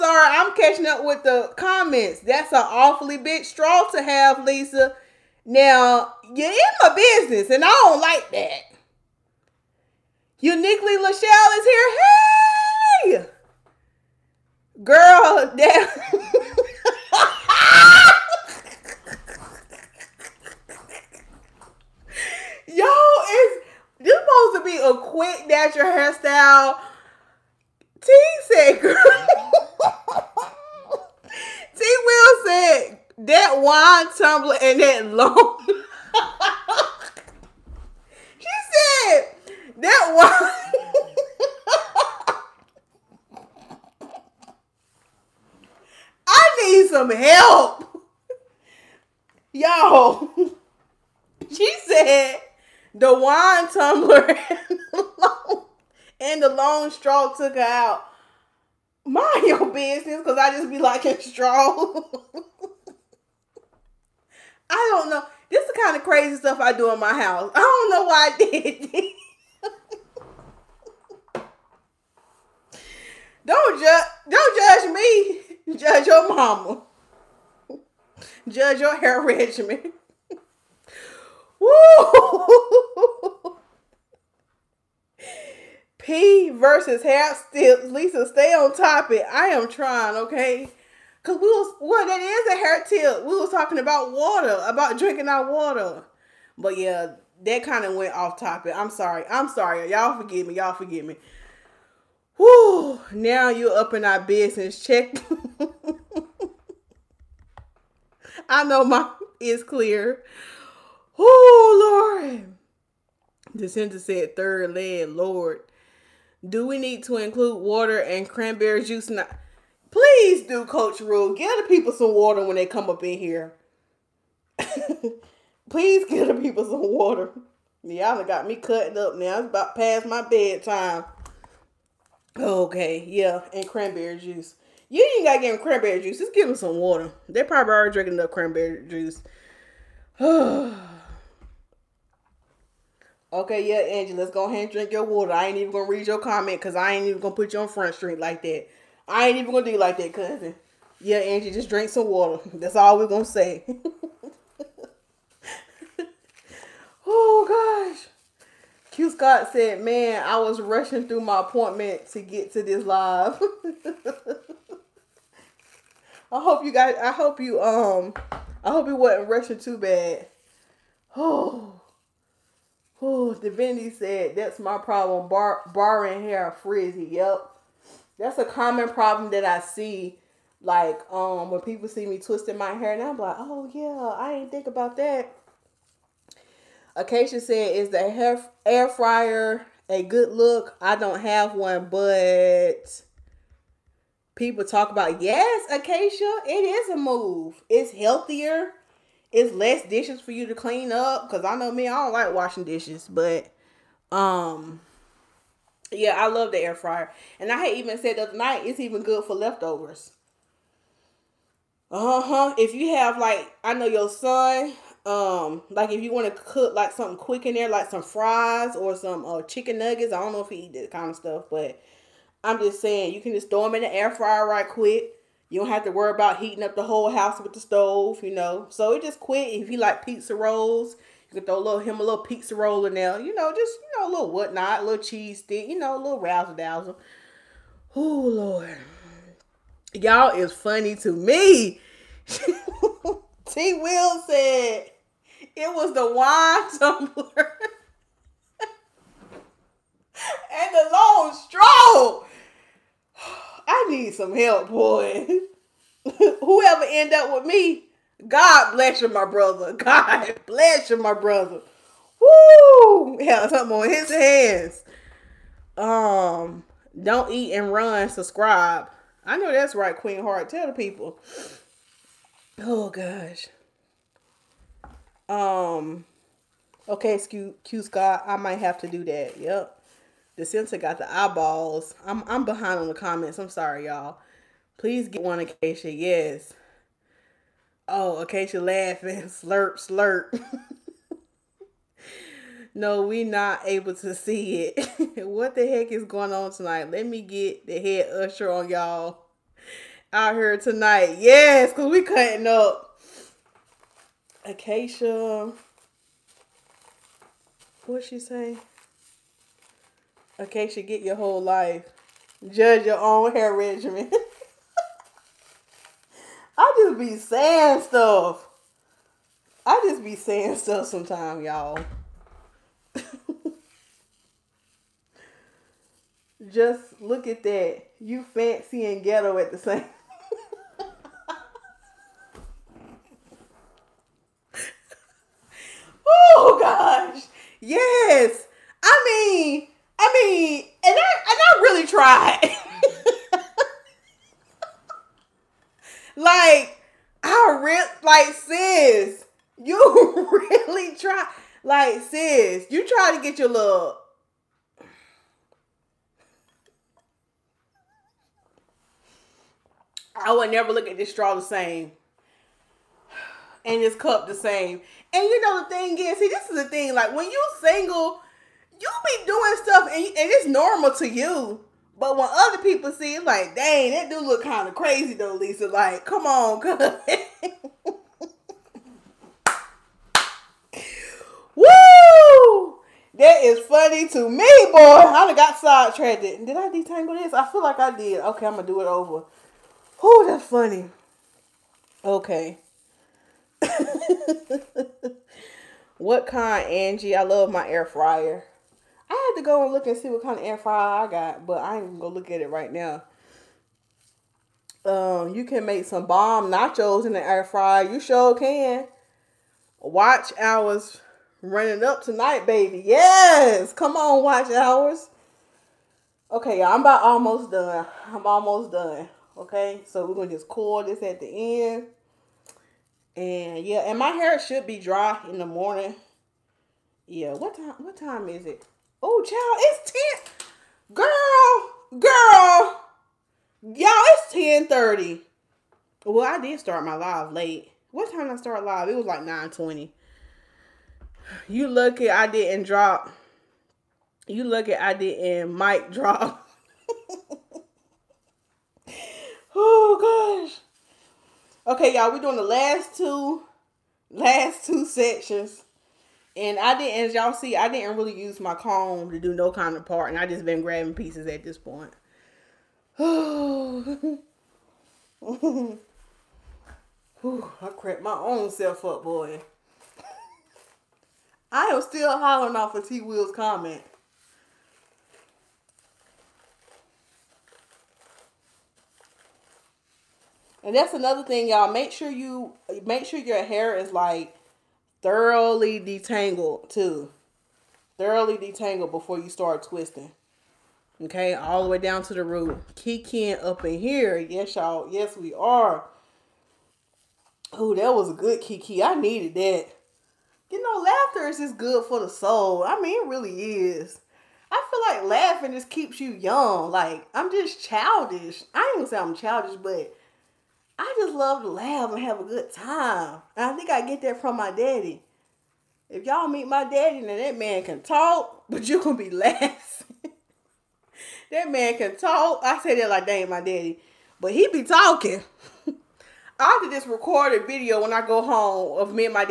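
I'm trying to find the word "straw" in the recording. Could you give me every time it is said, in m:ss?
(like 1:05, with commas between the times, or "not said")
0:03, 0:56, 1:01, 4:11, 6:01.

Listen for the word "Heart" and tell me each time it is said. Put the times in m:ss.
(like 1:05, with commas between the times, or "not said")
4:30.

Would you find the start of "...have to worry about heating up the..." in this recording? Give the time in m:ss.
3:45.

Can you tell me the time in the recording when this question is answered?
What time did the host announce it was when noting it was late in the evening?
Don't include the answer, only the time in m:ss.
7:14.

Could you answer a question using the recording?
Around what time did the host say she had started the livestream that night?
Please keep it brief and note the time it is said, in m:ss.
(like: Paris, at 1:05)
9:20, at 7:19.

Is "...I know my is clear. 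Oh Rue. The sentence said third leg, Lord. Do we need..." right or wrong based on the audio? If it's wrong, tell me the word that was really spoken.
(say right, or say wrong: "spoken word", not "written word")
wrong: "Lord", not "Rue".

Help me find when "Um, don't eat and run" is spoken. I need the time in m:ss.
4:25.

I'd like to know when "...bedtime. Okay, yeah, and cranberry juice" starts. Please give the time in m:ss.
2:10.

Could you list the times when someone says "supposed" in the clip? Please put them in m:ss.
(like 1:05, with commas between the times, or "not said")
0:24.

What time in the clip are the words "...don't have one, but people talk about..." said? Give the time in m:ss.
3:10.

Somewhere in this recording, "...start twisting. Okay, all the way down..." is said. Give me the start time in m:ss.
8:09.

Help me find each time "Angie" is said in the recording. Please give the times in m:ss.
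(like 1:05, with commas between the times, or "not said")
2:23, 2:31, 6:36.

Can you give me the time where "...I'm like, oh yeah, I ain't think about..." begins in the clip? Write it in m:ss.
3:03.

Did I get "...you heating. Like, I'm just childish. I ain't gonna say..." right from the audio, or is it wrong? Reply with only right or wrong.
wrong.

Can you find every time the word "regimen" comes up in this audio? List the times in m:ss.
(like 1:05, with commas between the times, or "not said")
1:19, 5:13.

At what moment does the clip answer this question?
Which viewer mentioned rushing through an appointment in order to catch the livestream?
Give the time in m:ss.
2:38.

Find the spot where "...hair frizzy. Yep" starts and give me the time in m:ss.
2:56.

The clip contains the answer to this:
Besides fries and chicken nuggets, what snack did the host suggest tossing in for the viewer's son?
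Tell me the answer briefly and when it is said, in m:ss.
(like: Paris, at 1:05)
pizza rolls, at 3:52.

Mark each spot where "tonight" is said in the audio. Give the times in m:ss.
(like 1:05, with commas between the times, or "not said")
4:56, 5:00, 6:52.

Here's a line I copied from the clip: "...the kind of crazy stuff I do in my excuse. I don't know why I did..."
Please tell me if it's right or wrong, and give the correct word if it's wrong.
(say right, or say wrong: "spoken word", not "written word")
wrong: "house", not "excuse".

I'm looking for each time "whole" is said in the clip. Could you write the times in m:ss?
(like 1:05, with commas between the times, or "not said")
3:46, 5:11.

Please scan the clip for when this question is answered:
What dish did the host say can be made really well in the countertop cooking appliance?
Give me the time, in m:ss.
6:46.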